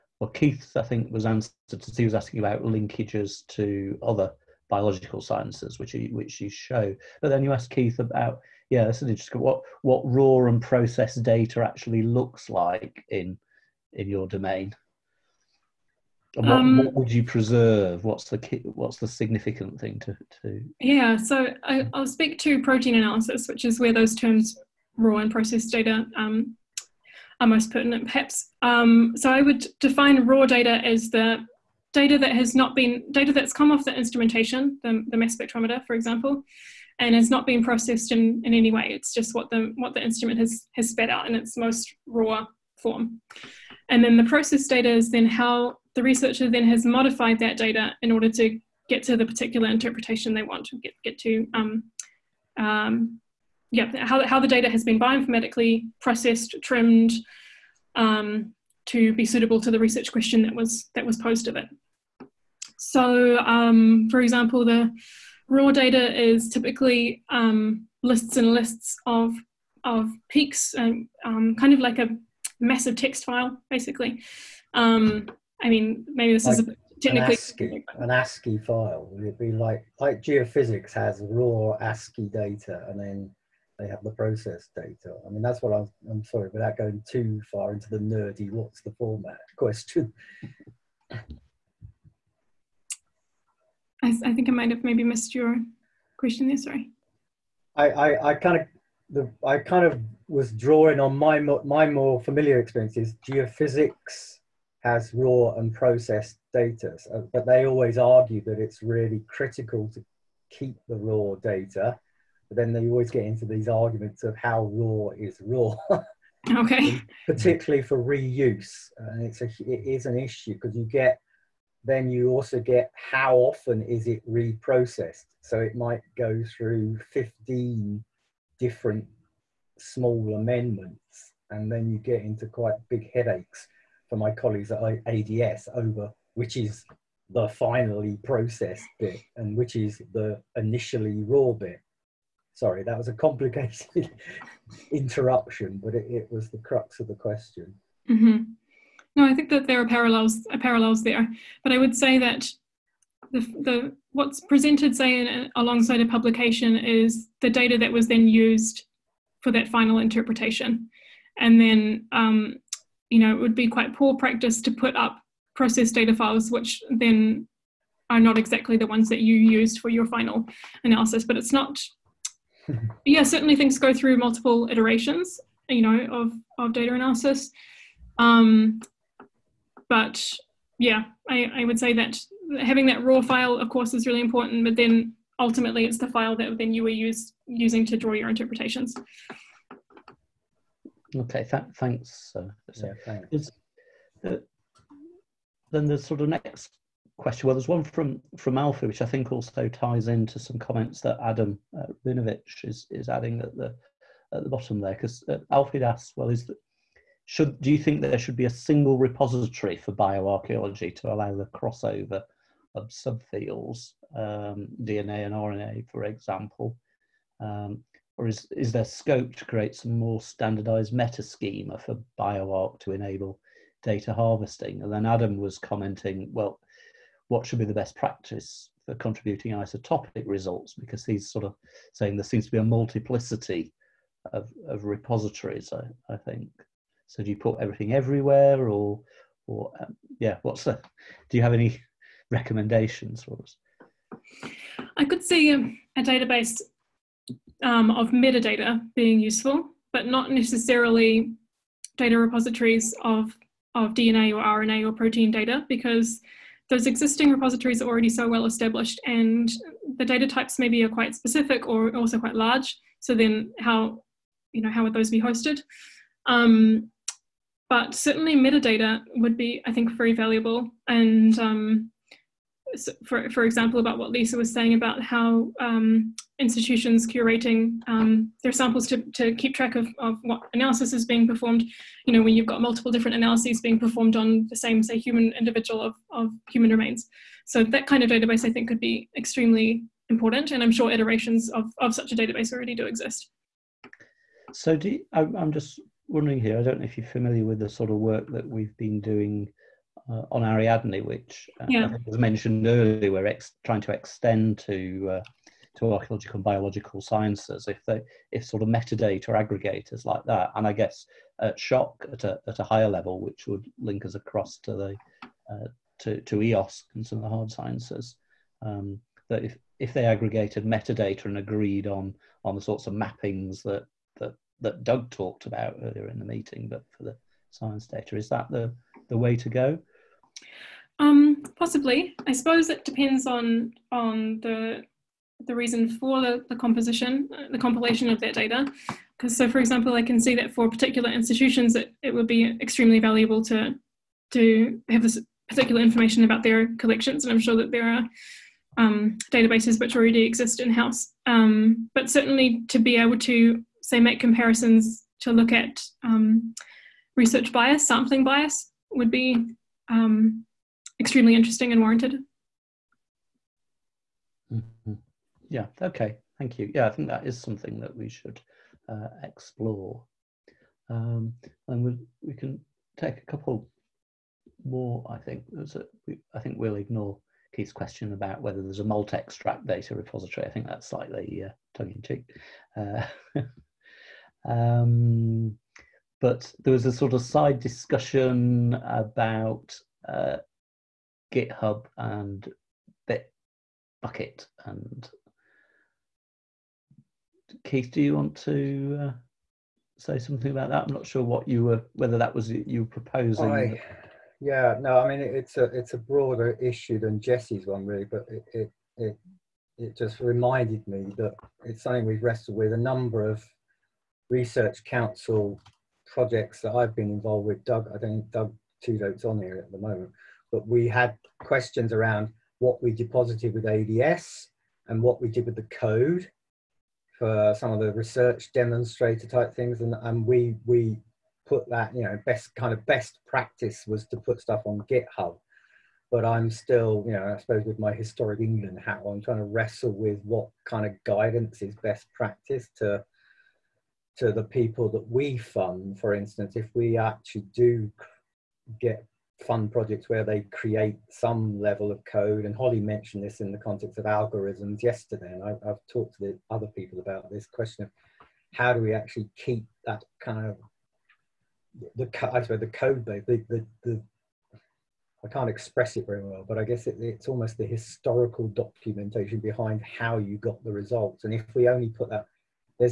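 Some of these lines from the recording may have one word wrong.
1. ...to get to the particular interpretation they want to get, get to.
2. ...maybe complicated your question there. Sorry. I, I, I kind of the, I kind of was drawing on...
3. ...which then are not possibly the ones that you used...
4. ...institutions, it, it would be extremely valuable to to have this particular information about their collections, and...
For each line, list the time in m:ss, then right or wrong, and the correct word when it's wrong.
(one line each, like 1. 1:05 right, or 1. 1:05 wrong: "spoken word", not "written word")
1. 0:48 right
2. 1:34 wrong: "missed", not "complicated"
3. 2:46 wrong: "exactly", not "possibly"
4. 5:41 right.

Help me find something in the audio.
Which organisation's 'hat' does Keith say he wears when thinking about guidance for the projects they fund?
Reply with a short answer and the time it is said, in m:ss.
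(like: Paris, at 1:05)
Historic England, at 7:17.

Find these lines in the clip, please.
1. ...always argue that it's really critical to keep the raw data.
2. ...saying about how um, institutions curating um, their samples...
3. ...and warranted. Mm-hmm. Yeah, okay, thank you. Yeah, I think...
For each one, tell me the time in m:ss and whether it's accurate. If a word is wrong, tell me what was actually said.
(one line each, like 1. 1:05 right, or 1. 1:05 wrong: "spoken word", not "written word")
1. 1:47 right
2. 4:34 right
3. 6:01 right.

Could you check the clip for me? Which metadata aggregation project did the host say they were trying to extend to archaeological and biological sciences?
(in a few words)
Ariadne.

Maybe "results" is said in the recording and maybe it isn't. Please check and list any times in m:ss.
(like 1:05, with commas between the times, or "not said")
3:50, 7:50.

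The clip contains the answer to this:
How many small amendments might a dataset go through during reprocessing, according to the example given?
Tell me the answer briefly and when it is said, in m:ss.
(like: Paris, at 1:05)
15, at 2:07.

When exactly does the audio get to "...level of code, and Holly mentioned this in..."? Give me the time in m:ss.
7:31.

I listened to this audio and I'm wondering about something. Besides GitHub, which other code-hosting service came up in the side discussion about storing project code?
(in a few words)
Bitbucket.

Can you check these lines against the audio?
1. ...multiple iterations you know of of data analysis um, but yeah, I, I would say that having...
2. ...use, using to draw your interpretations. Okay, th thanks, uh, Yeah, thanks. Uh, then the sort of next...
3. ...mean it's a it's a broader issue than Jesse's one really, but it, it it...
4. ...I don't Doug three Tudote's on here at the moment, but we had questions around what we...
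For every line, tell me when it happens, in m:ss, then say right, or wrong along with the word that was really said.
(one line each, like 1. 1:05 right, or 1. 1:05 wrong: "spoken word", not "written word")
1. 2:54 right
2. 3:06 right
3. 6:45 right
4. 6:57 wrong: "two", not "three".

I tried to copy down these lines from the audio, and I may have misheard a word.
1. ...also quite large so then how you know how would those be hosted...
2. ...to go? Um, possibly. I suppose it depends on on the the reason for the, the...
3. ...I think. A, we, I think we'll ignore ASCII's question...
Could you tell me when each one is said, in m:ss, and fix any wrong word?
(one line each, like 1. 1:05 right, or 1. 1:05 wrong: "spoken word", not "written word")
1. 4:21 right
2. 5:29 right
3. 6:15 wrong: "Keith", not "ASCII".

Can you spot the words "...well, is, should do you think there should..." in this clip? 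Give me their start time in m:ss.
3:26.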